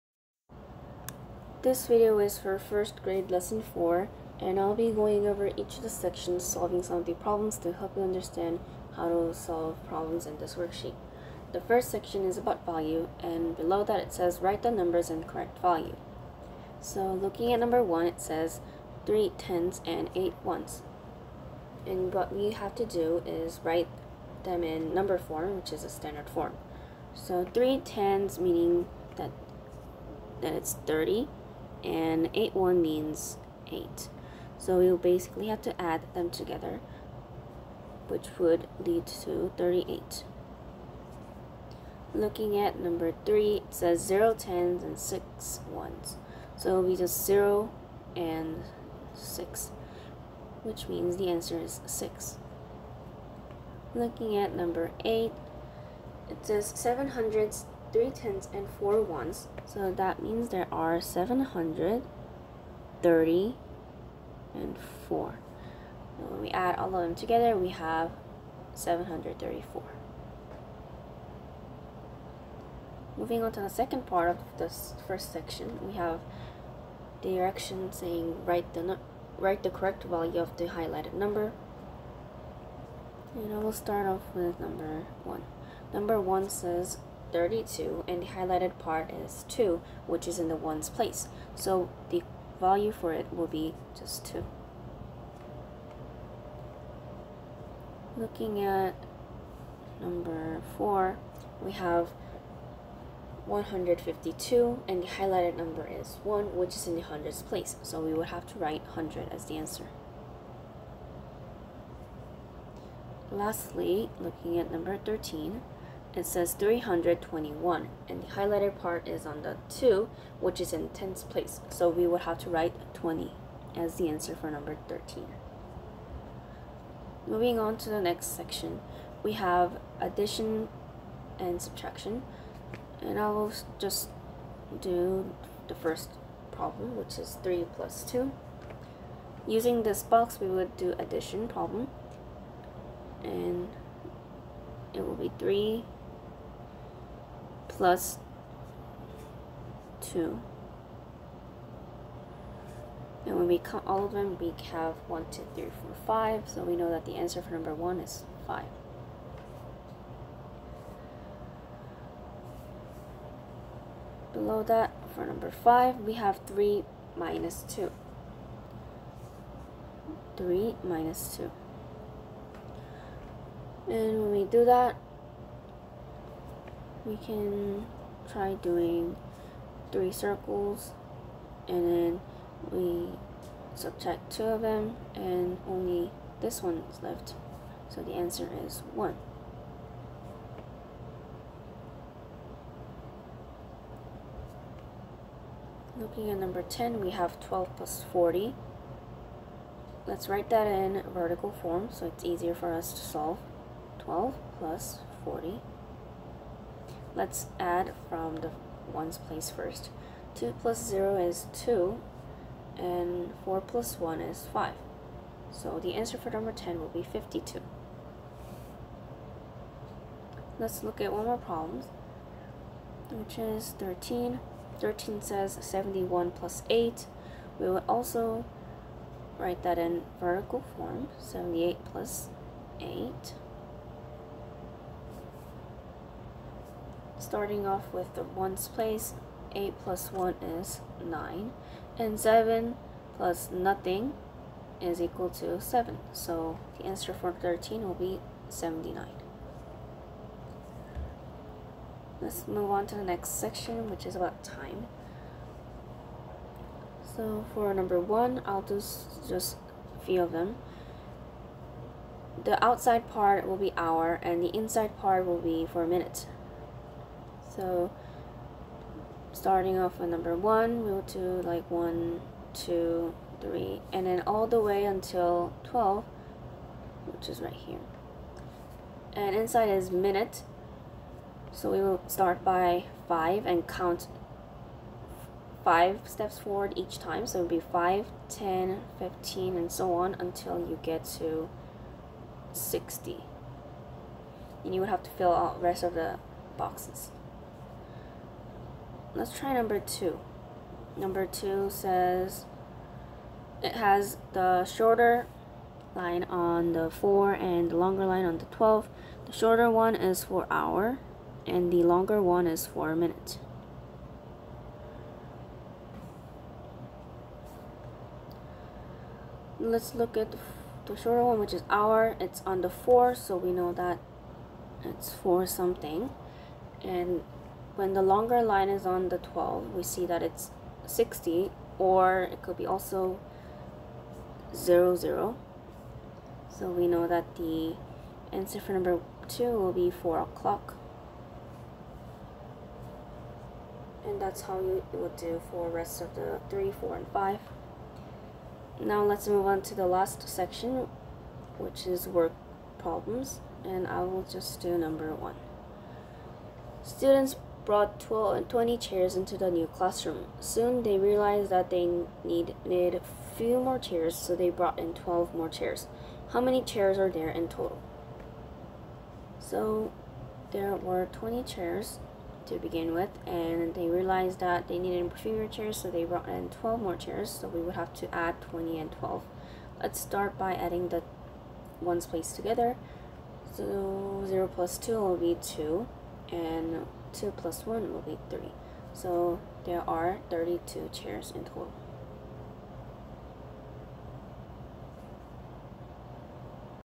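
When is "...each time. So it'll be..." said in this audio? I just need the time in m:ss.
4:46.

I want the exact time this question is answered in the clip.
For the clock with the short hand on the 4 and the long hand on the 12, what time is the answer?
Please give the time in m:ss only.
5:39.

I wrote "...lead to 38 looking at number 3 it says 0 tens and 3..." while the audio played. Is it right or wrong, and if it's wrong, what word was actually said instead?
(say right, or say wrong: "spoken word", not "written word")
wrong: "6", not "3".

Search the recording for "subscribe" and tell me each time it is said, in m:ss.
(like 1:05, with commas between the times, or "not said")
not said.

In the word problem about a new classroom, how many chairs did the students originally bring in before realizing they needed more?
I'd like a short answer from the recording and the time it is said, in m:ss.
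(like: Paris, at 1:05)
20, at 6:11.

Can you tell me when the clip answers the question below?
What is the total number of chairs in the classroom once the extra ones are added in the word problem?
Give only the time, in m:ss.
6:30.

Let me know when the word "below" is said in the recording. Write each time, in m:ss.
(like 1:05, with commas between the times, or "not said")
0:13, 2:44.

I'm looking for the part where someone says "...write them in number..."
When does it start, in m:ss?
0:23.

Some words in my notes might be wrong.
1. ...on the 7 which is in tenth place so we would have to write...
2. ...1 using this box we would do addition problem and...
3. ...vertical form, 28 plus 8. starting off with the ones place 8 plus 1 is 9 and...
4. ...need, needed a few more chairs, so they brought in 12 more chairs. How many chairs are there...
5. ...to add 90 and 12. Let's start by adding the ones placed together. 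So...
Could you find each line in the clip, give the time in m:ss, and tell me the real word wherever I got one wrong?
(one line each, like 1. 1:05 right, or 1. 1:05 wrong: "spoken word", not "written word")
1. 1:59 wrong: "2", not "7"
2. 2:18 wrong: "2", not "1"
3. 3:50 wrong: "78", not "28"
4. 6:02 right
5. 6:17 wrong: "20", not "90".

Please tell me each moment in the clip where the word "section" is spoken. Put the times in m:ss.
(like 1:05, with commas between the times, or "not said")
0:05, 0:11, 1:15, 2:08, 4:13, 5:50.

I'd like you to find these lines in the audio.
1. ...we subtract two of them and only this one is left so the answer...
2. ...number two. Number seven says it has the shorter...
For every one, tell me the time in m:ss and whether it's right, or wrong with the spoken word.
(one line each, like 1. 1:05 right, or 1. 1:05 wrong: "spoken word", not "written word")
1. 3:02 right
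2. 4:59 wrong: "two", not "seven".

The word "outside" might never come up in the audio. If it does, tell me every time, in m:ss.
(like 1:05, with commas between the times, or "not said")
4:22.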